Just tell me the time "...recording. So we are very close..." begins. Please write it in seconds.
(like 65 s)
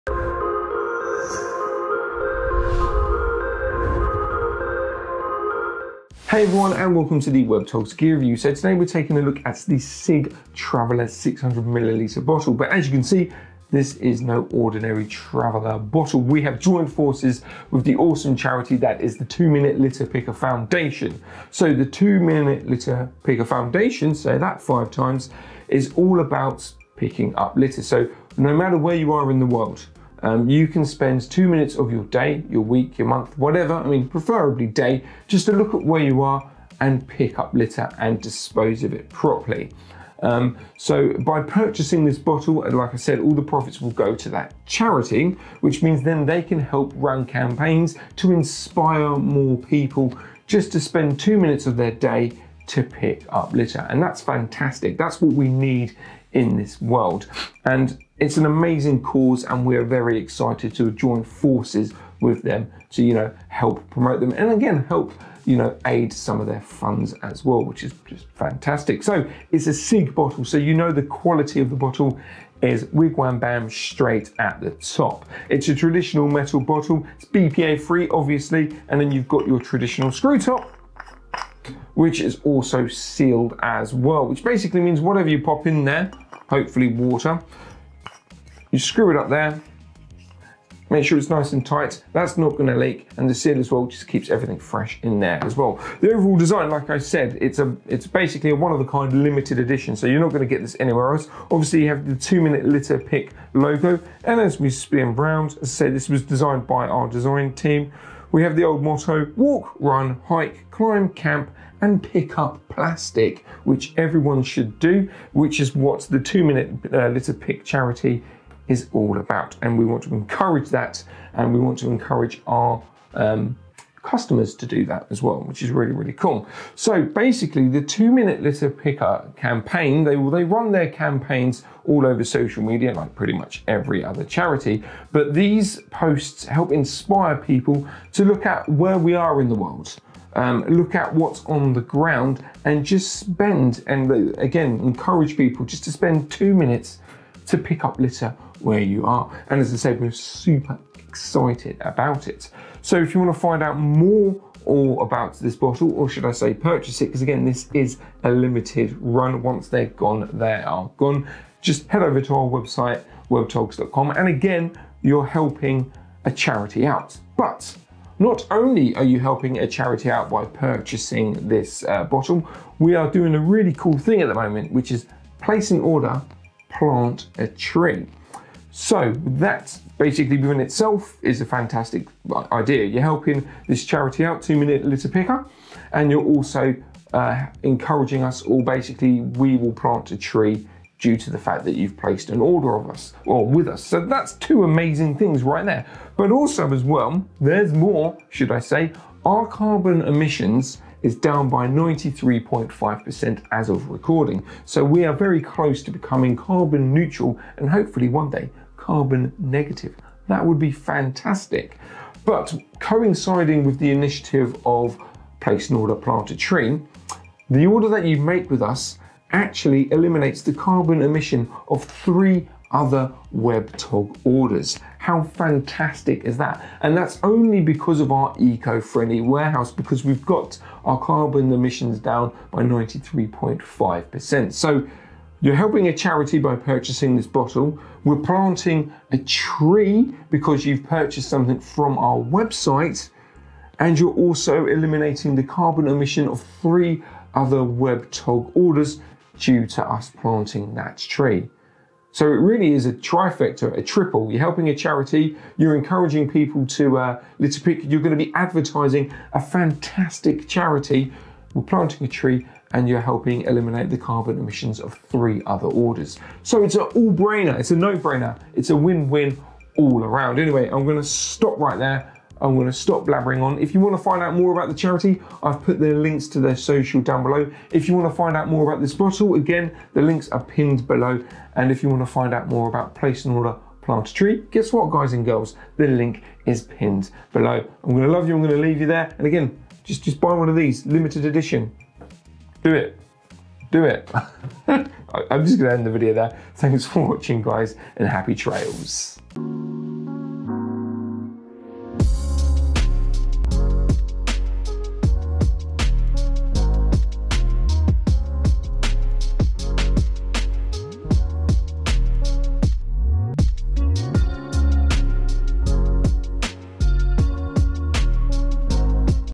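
203 s.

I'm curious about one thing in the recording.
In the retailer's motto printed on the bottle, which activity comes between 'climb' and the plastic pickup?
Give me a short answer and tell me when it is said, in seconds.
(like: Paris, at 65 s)
Camp, at 111 s.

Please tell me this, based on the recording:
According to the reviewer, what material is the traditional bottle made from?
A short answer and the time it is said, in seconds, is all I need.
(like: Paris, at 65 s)
Metal, at 76 s.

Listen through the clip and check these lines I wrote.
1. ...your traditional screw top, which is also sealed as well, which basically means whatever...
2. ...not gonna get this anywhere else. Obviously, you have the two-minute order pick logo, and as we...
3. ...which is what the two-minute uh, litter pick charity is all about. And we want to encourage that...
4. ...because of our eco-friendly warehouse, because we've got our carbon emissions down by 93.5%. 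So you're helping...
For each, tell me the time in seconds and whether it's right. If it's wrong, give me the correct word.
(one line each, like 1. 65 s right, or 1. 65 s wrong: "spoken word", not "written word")
1. 79 s right
2. 100 s wrong: "litter", not "order"
3. 115 s right
4. 227 s right.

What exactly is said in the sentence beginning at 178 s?
So that basically within itself is a fantastic idea.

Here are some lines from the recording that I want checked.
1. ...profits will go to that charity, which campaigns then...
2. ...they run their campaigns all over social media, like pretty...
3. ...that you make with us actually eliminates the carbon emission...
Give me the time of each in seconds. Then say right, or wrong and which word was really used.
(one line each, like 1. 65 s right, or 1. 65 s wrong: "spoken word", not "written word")
1. 43 s wrong: "means", not "campaigns"
2. 130 s right
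3. 217 s right.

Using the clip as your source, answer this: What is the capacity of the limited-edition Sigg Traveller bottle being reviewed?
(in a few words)
600ml.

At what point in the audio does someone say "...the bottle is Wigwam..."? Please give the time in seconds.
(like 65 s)
71 s.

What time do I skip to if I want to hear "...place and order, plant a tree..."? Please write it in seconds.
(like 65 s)
282 s.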